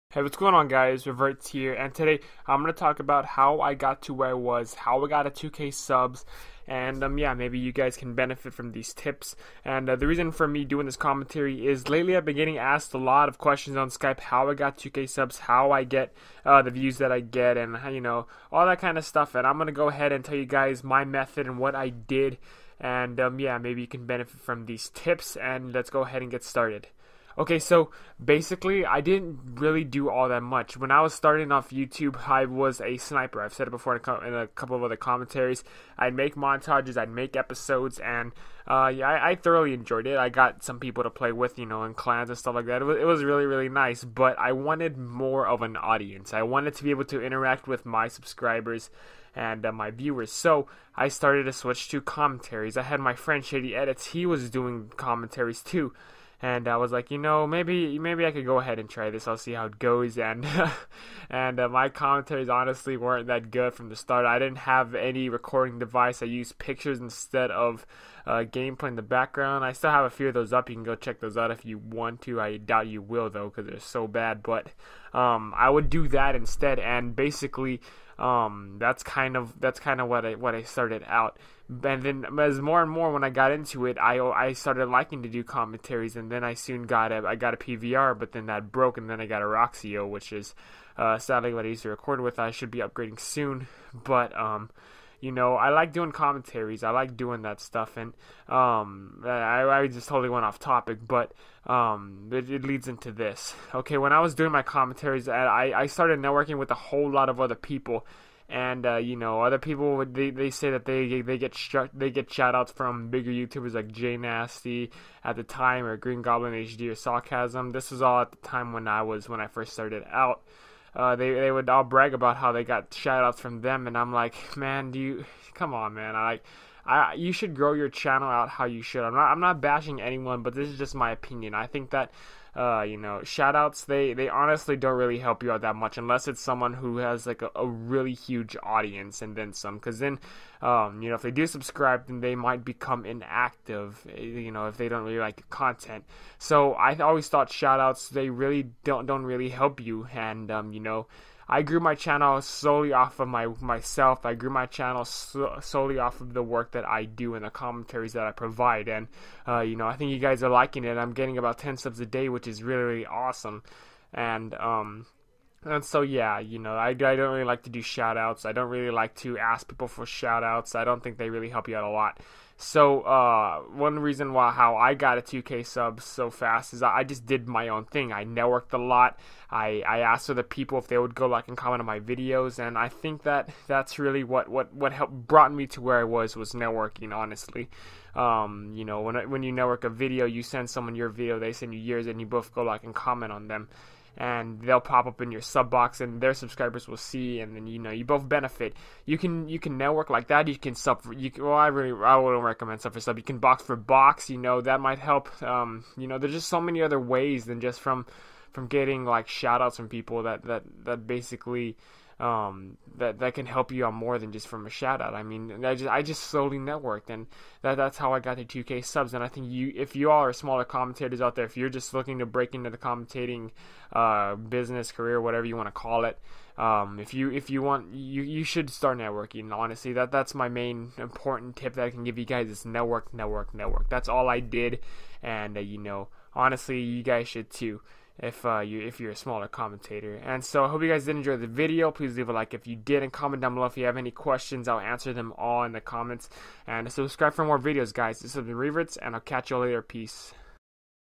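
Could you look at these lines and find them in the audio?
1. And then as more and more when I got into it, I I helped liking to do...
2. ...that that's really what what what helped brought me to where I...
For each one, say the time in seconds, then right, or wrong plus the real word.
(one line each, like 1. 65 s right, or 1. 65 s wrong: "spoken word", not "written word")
1. 81 s wrong: "started", not "helped"
2. 183 s right.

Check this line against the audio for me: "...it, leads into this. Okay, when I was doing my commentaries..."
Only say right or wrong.
right.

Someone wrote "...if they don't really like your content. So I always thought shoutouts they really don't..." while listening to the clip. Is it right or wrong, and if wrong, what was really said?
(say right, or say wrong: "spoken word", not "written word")
right.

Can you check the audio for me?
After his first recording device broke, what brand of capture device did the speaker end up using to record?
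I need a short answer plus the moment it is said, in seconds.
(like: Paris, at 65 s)
Roxio, at 89 s.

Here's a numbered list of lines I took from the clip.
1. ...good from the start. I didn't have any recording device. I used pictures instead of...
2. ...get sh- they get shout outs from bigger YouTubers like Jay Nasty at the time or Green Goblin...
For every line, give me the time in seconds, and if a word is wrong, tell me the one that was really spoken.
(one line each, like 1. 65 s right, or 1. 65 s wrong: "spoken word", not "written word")
1. 63 s right
2. 111 s right.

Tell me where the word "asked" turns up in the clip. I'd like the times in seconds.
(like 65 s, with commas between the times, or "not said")
12 s, 179 s.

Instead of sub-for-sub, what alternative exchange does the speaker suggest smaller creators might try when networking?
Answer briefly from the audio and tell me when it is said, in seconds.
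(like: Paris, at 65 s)
box for box, at 203 s.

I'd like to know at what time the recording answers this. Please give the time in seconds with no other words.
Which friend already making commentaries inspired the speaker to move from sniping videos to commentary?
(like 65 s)
53 s.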